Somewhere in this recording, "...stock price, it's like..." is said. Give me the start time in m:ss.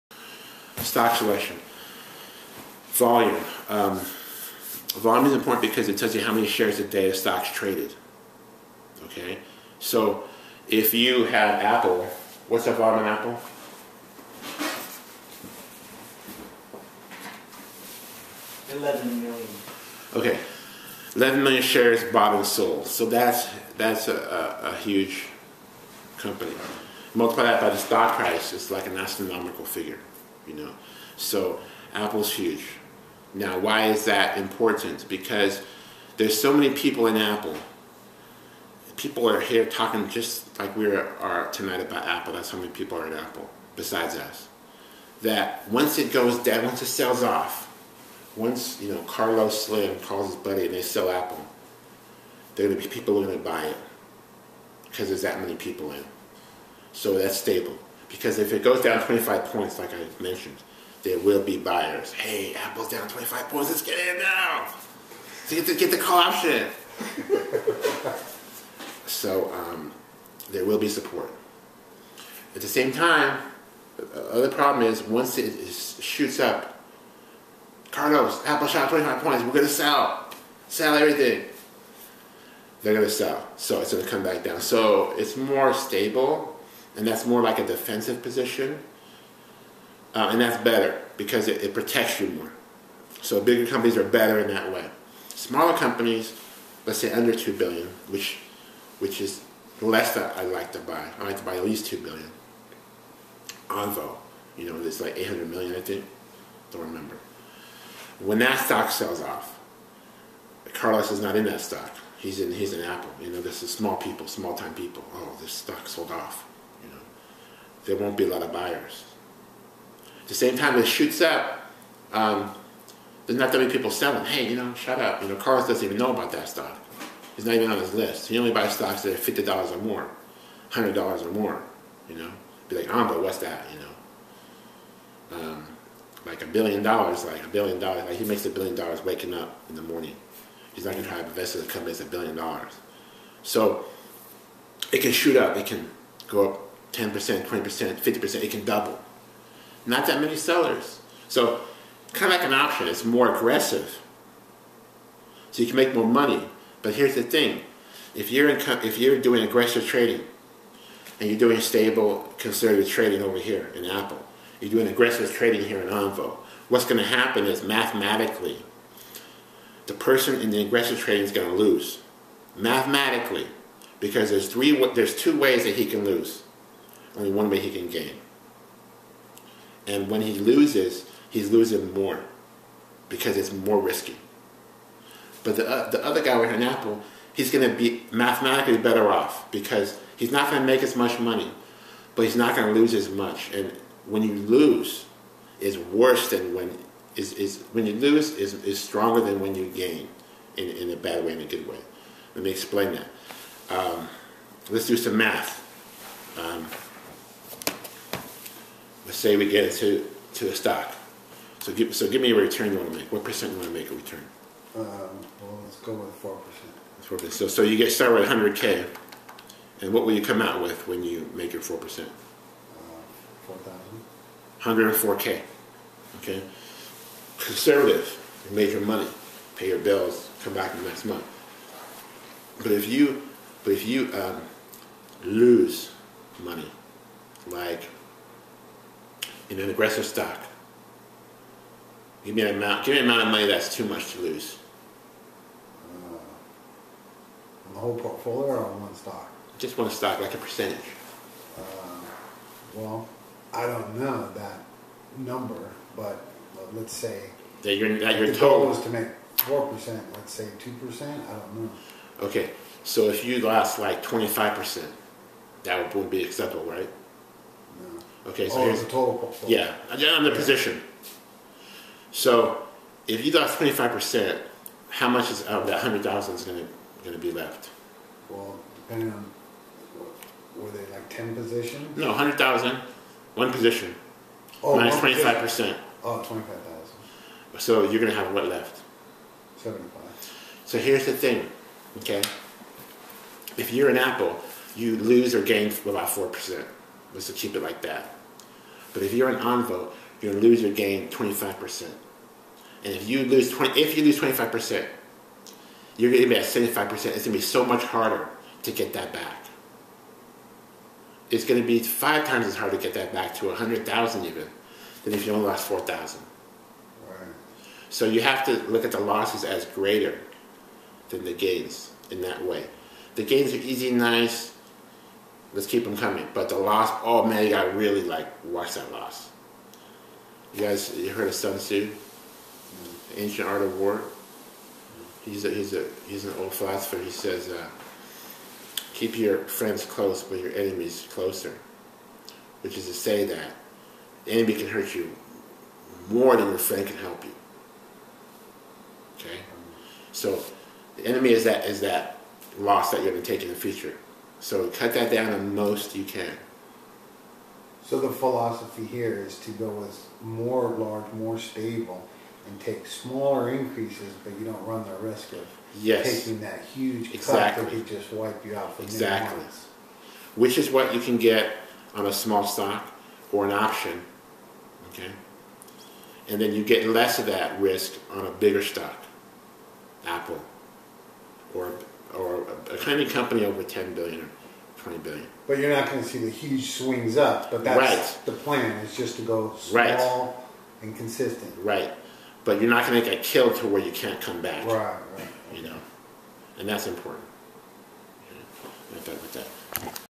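0:27.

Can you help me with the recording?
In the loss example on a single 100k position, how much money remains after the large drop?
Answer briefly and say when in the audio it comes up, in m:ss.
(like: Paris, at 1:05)
75,000, at 4:49.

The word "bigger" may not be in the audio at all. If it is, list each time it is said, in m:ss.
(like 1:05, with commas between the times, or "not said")
1:33, 6:18.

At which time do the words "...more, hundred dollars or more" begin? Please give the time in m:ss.
2:09.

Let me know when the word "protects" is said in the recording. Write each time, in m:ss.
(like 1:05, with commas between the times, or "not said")
1:31.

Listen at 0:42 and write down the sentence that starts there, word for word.
That's how many people are at Apple, besides us.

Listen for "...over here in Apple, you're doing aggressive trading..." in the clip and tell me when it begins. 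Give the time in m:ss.
2:43.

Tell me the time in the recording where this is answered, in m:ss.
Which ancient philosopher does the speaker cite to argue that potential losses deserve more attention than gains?
5:31.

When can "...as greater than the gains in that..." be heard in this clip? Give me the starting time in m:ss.
5:19.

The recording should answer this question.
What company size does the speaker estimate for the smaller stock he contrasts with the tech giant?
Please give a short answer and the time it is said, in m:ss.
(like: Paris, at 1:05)
800 million, at 1:45.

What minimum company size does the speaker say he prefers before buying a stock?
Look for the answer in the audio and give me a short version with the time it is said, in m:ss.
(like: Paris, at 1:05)
2 billion, at 1:41.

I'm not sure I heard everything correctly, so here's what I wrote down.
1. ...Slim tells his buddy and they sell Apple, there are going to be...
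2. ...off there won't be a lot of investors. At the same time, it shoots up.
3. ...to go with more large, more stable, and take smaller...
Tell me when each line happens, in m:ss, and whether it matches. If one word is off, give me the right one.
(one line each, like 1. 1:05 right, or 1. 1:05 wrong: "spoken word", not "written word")
1. 0:49 wrong: "calls", not "tells"
2. 1:56 wrong: "buyers", not "investors"
3. 5:59 right.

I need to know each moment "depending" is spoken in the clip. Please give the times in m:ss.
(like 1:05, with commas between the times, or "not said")
4:38.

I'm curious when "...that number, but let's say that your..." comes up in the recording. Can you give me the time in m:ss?
4:14.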